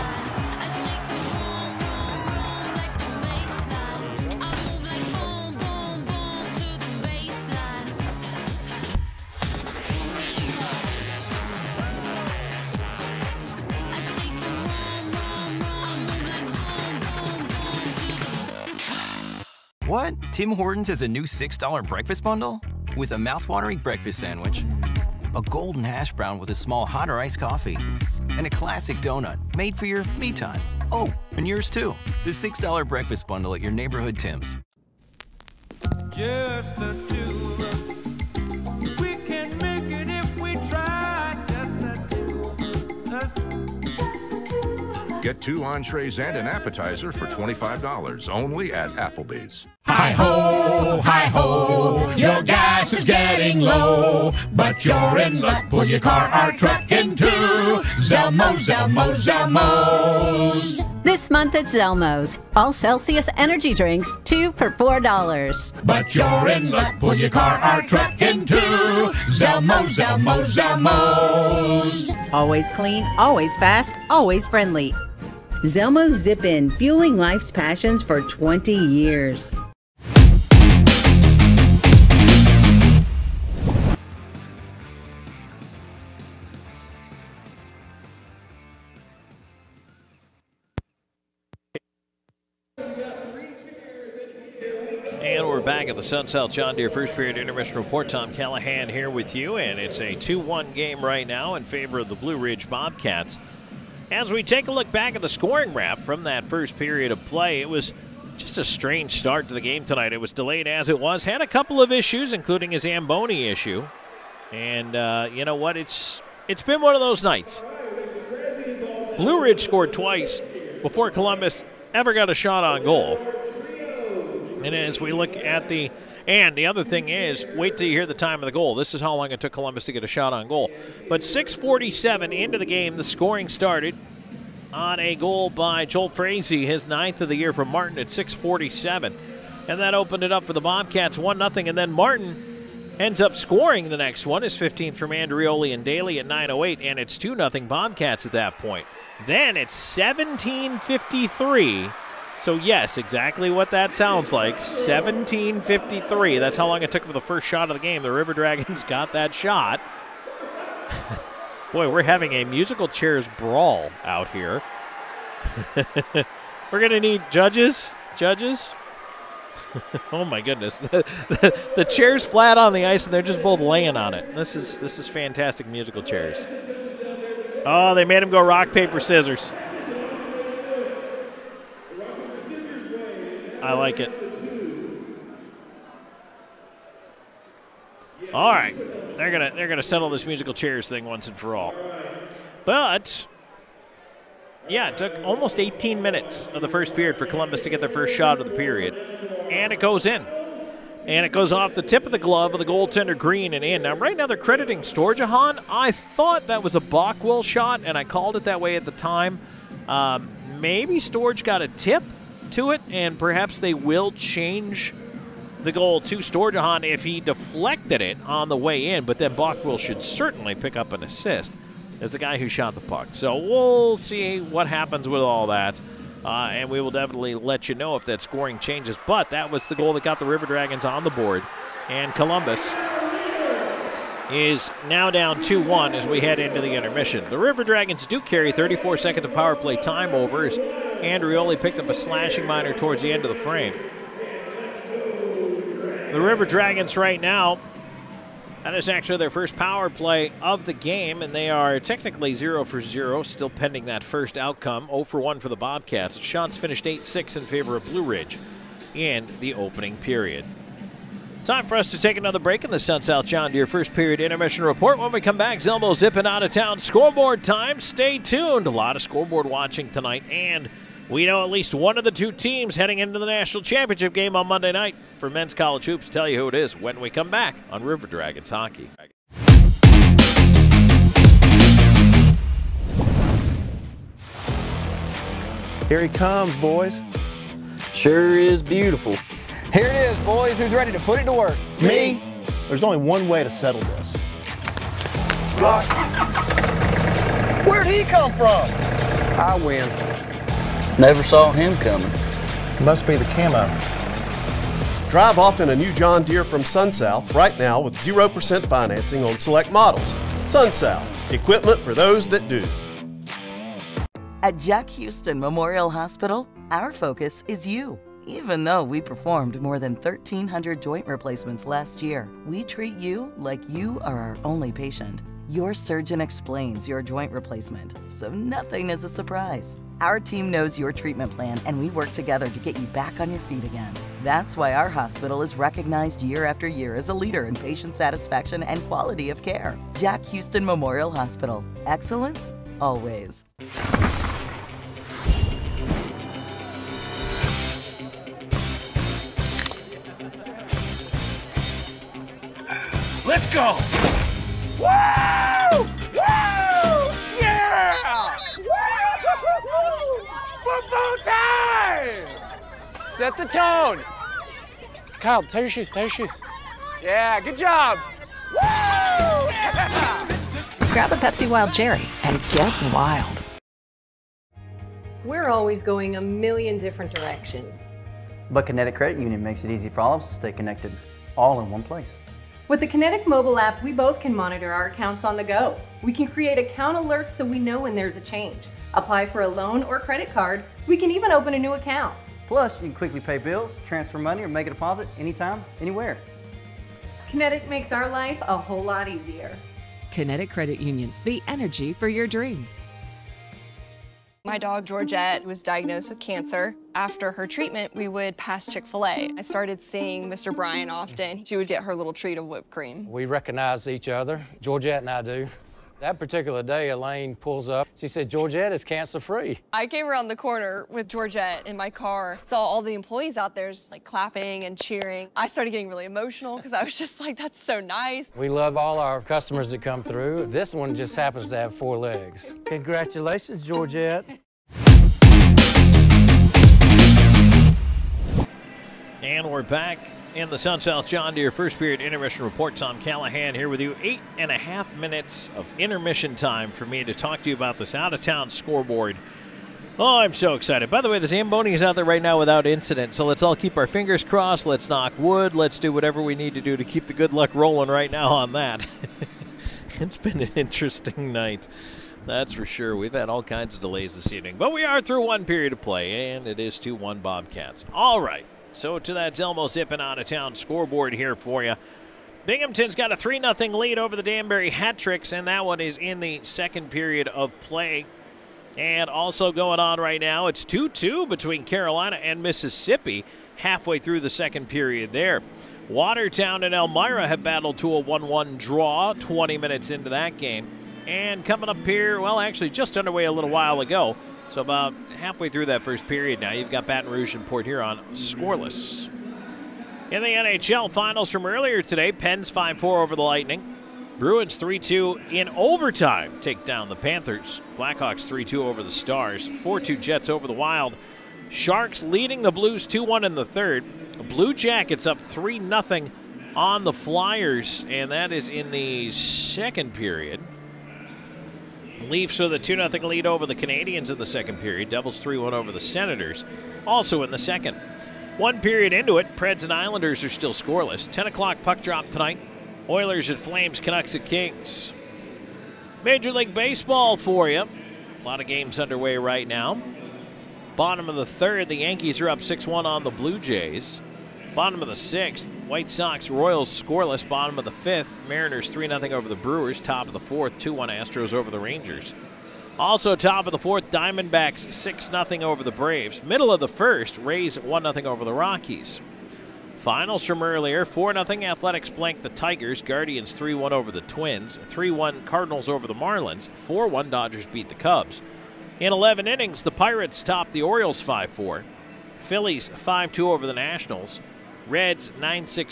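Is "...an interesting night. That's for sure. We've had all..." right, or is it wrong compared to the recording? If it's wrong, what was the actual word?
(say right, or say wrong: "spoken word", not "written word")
right.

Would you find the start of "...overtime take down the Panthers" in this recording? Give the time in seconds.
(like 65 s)
505 s.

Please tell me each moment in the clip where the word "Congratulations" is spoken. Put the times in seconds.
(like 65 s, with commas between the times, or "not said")
432 s.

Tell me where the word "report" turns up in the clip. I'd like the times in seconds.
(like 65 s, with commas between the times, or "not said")
97 s, 264 s, 442 s.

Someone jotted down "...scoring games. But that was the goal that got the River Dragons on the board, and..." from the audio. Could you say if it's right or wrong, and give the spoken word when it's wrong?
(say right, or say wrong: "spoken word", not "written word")
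wrong: "changes", not "games".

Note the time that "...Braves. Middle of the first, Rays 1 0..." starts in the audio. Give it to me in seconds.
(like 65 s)
555 s.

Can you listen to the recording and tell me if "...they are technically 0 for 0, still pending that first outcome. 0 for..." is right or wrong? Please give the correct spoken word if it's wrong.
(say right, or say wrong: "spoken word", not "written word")
right.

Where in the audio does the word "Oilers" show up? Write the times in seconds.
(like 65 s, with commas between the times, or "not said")
532 s.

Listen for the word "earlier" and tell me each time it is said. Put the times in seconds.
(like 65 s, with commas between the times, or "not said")
501 s, 560 s.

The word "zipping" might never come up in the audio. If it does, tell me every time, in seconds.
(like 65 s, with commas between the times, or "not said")
265 s, 469 s.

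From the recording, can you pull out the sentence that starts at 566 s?
4 1 Dodgers beat the Cubs.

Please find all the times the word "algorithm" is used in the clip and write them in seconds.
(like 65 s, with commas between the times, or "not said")
not said.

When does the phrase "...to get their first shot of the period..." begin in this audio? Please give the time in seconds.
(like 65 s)
197 s.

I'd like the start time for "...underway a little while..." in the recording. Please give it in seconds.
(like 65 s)
492 s.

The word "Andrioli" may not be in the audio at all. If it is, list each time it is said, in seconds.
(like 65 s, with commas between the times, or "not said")
145 s, 240 s.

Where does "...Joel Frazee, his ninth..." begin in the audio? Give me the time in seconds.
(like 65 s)
135 s.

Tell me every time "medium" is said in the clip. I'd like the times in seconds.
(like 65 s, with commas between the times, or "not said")
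not said.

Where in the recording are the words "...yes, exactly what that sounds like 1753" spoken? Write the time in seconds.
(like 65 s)
152 s.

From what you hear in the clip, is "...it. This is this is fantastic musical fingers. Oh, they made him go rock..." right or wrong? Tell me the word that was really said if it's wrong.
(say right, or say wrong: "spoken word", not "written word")
wrong: "chairs", not "fingers".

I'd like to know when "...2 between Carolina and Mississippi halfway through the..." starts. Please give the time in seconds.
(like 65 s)
480 s.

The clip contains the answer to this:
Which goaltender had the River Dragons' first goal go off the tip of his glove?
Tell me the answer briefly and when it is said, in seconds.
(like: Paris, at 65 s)
Green, at 203 s.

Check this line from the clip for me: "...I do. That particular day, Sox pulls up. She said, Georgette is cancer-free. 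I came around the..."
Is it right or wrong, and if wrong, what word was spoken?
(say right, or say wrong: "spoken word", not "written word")
wrong: "Elaine", not "Sox".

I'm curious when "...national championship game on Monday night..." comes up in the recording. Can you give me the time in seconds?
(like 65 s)
273 s.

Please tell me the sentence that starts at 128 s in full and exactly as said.
This is how long it took Columbus to get a shot on goal.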